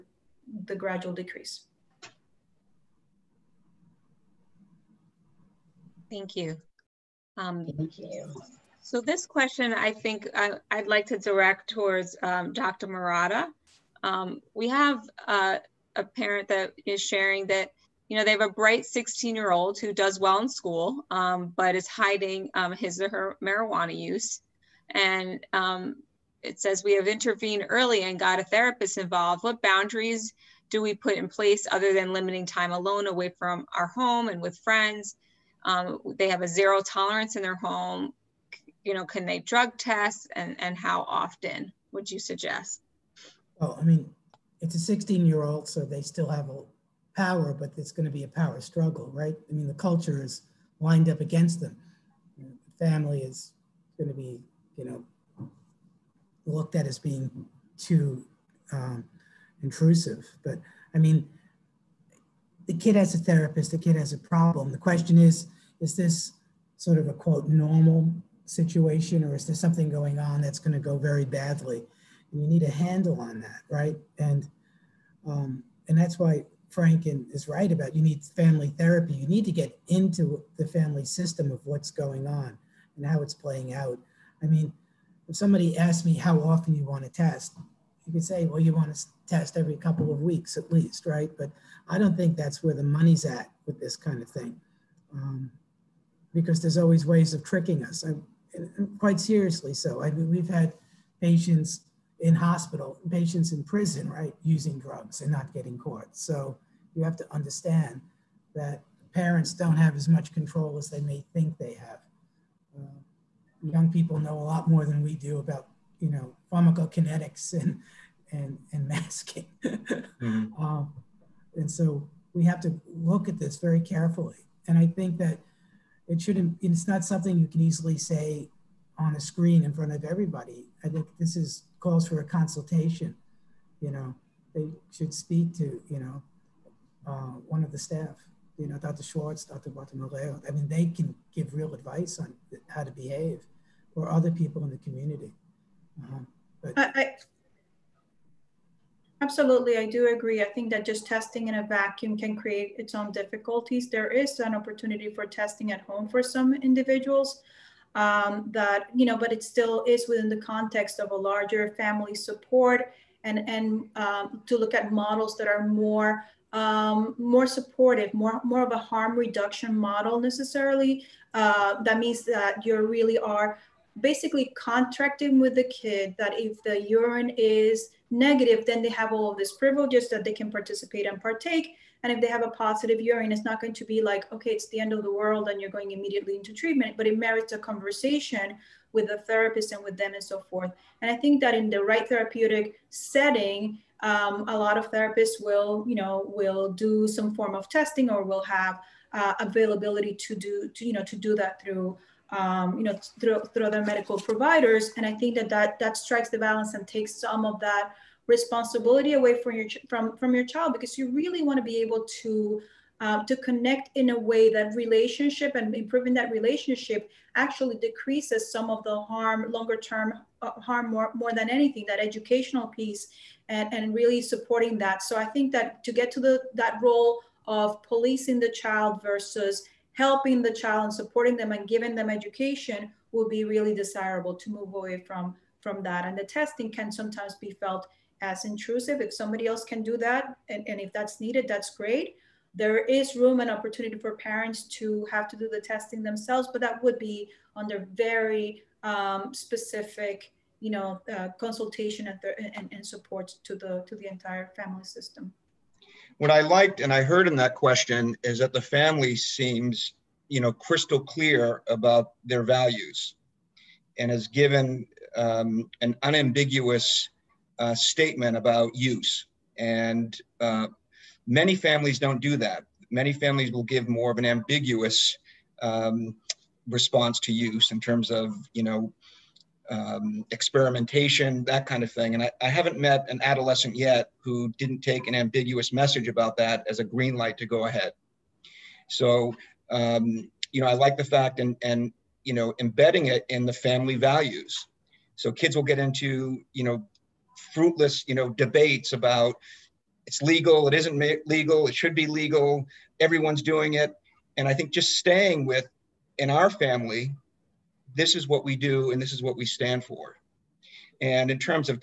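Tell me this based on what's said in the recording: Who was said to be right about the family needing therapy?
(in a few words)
Frank.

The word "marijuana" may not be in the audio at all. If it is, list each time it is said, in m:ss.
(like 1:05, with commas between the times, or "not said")
0:23.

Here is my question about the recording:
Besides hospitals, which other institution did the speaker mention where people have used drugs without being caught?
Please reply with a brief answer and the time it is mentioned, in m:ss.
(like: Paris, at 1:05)
prison, at 1:43.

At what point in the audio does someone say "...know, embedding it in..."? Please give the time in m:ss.
4:52.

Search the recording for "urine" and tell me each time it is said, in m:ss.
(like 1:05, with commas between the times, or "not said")
2:56, 3:02.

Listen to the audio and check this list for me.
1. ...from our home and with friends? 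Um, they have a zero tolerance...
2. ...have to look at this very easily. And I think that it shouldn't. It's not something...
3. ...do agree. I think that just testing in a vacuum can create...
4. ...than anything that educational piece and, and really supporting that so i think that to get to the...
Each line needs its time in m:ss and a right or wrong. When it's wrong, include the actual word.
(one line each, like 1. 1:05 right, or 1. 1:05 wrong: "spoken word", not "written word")
1. 0:33 right
2. 2:02 wrong: "carefully", not "easily"
3. 2:29 right
4. 3:41 right.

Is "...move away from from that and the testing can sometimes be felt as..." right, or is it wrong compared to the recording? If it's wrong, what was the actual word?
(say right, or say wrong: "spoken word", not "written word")
right.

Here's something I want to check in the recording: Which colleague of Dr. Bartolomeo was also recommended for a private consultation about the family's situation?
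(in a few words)
Dr. Schwartz.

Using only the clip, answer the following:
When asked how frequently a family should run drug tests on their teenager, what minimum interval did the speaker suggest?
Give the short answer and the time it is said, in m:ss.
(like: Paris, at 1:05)
every couple of weeks, at 1:29.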